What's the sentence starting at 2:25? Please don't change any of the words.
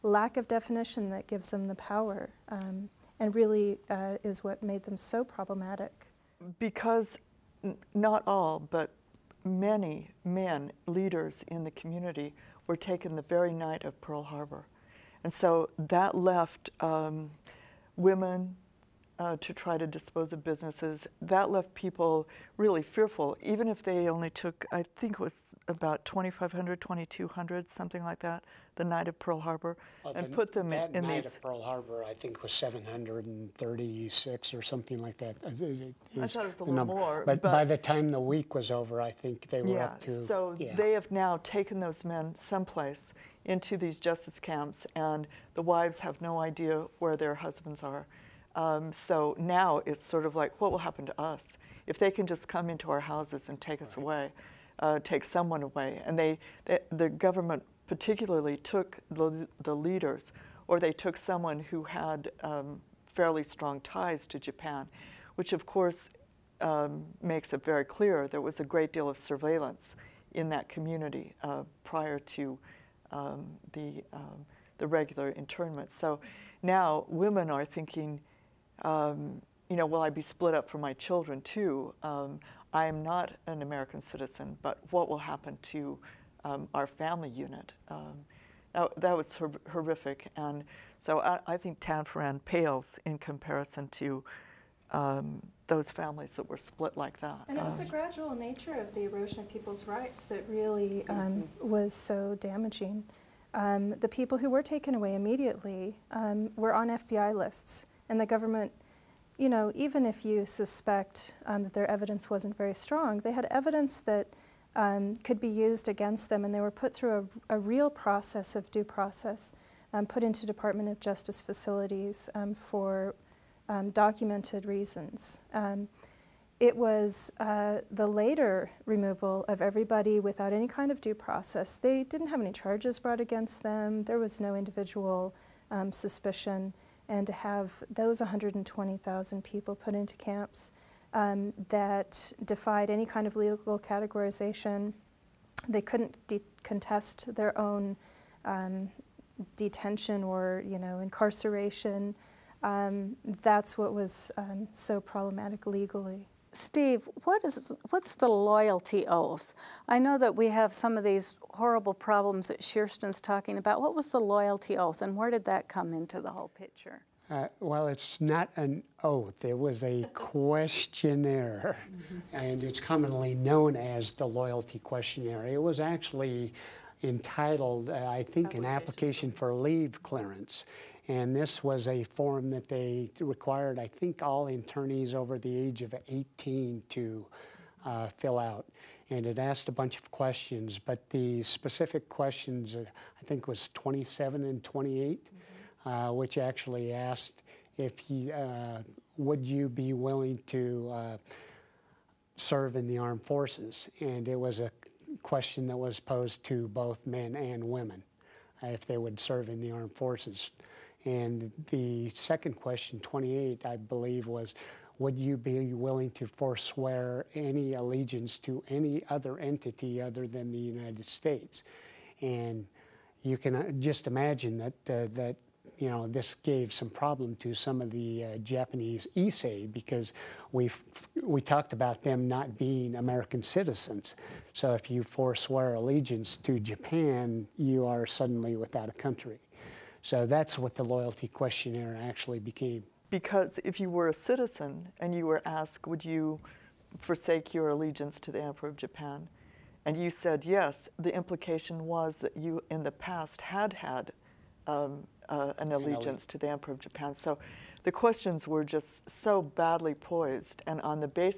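They couldn't contest their own um, detention or you know incarceration.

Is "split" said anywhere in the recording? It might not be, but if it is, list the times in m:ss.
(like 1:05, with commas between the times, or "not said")
1:20, 1:36.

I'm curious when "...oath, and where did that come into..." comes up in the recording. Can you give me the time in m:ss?
2:44.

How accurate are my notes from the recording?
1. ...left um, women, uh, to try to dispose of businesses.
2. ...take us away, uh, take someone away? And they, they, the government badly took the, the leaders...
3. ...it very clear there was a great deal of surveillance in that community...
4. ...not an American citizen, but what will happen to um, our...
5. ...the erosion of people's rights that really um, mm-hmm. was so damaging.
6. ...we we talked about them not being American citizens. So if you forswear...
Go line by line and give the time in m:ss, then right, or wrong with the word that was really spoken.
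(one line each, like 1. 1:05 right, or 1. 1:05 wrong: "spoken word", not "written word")
1. 0:16 right
2. 0:53 wrong: "particularly", not "badly"
3. 1:07 right
4. 1:23 right
5. 1:38 right
6. 3:50 right.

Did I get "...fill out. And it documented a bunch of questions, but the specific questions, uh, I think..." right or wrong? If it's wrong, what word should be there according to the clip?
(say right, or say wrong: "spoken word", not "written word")
wrong: "asked", not "documented".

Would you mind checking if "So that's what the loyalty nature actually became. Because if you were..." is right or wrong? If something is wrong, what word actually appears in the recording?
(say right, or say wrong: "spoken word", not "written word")
wrong: "questionnaire", not "nature".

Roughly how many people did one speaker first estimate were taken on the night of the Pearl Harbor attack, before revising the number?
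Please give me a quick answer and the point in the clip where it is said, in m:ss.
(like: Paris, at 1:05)
2,500, at 0:26.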